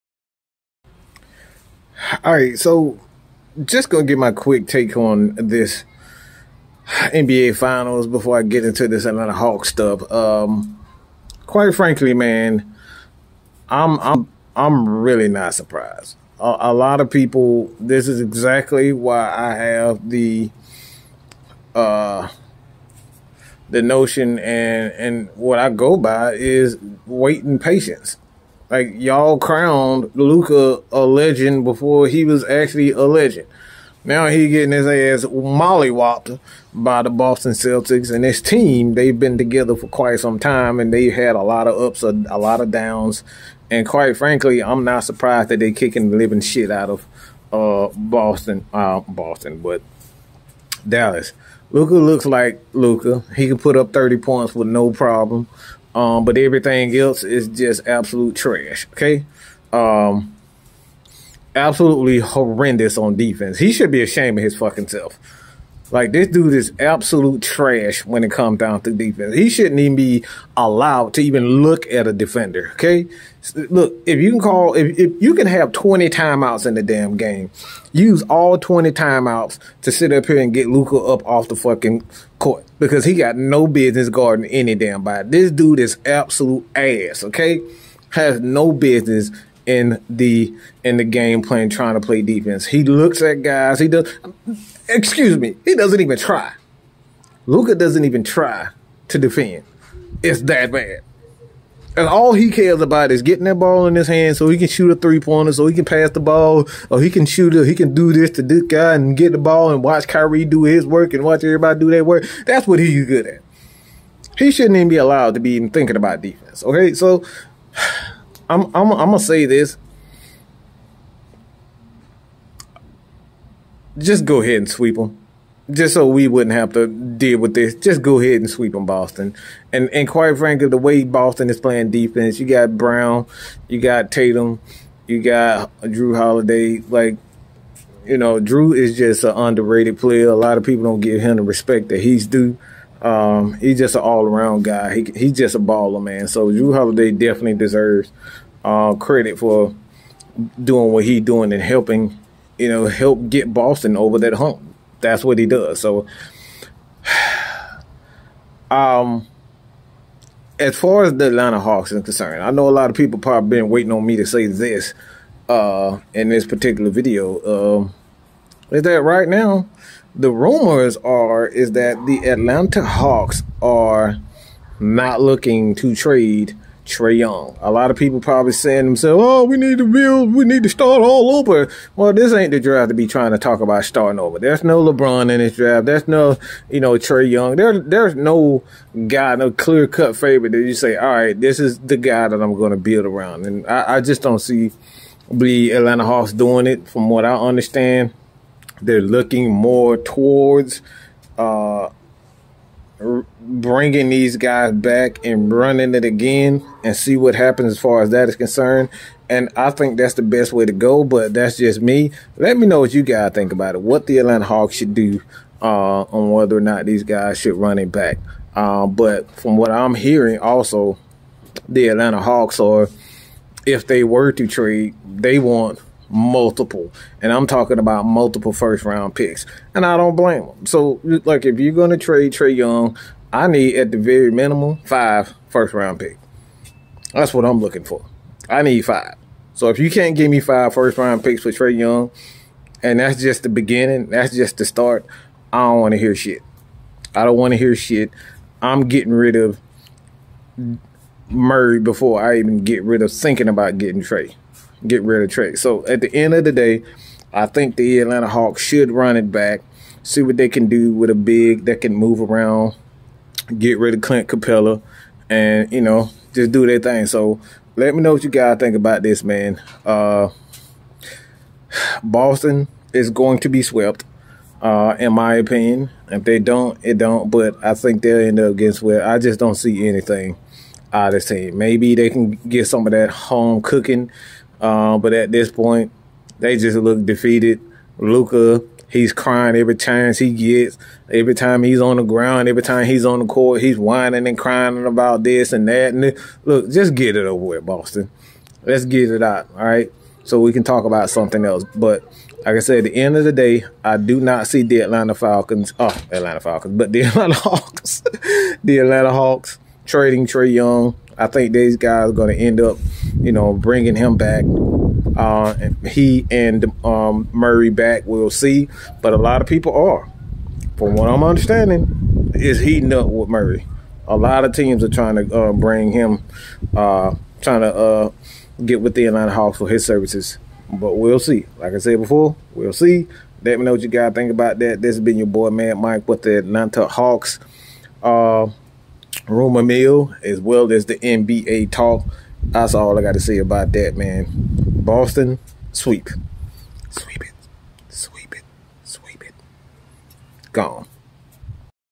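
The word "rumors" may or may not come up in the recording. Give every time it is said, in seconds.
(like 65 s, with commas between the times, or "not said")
170 s, 339 s.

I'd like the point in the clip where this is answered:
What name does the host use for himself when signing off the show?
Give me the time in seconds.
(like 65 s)
335 s.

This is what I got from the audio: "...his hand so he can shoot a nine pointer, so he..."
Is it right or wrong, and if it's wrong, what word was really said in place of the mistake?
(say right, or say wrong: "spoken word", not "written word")
wrong: "three", not "nine".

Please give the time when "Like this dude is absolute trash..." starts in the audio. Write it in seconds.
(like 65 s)
65 s.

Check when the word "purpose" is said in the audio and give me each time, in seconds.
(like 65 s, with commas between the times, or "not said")
not said.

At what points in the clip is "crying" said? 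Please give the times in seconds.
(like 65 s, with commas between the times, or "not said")
289 s, 294 s.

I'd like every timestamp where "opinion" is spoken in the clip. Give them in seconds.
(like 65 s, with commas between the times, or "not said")
275 s.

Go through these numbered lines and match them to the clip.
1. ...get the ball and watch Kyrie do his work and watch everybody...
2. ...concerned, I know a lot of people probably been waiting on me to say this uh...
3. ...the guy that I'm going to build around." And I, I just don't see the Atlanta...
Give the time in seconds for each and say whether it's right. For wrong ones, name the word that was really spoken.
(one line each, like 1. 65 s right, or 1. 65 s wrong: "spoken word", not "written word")
1. 109 s right
2. 162 s right
3. 191 s right.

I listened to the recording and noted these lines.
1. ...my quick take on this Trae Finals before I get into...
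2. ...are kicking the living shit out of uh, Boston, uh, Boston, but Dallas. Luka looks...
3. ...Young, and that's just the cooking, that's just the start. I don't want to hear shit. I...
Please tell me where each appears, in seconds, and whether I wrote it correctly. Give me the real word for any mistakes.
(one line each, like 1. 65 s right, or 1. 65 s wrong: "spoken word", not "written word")
1. 4 s wrong: "NBA", not "Trae"
2. 45 s right
3. 241 s wrong: "beginning", not "cooking".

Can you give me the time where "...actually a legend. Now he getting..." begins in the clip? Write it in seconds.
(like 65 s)
32 s.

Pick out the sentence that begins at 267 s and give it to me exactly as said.
So let me know what you guys think about this, man.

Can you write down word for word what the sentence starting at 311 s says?
I think these guys are going to end up, you know, bringing him back.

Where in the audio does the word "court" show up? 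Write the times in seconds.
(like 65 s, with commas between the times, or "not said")
82 s, 293 s.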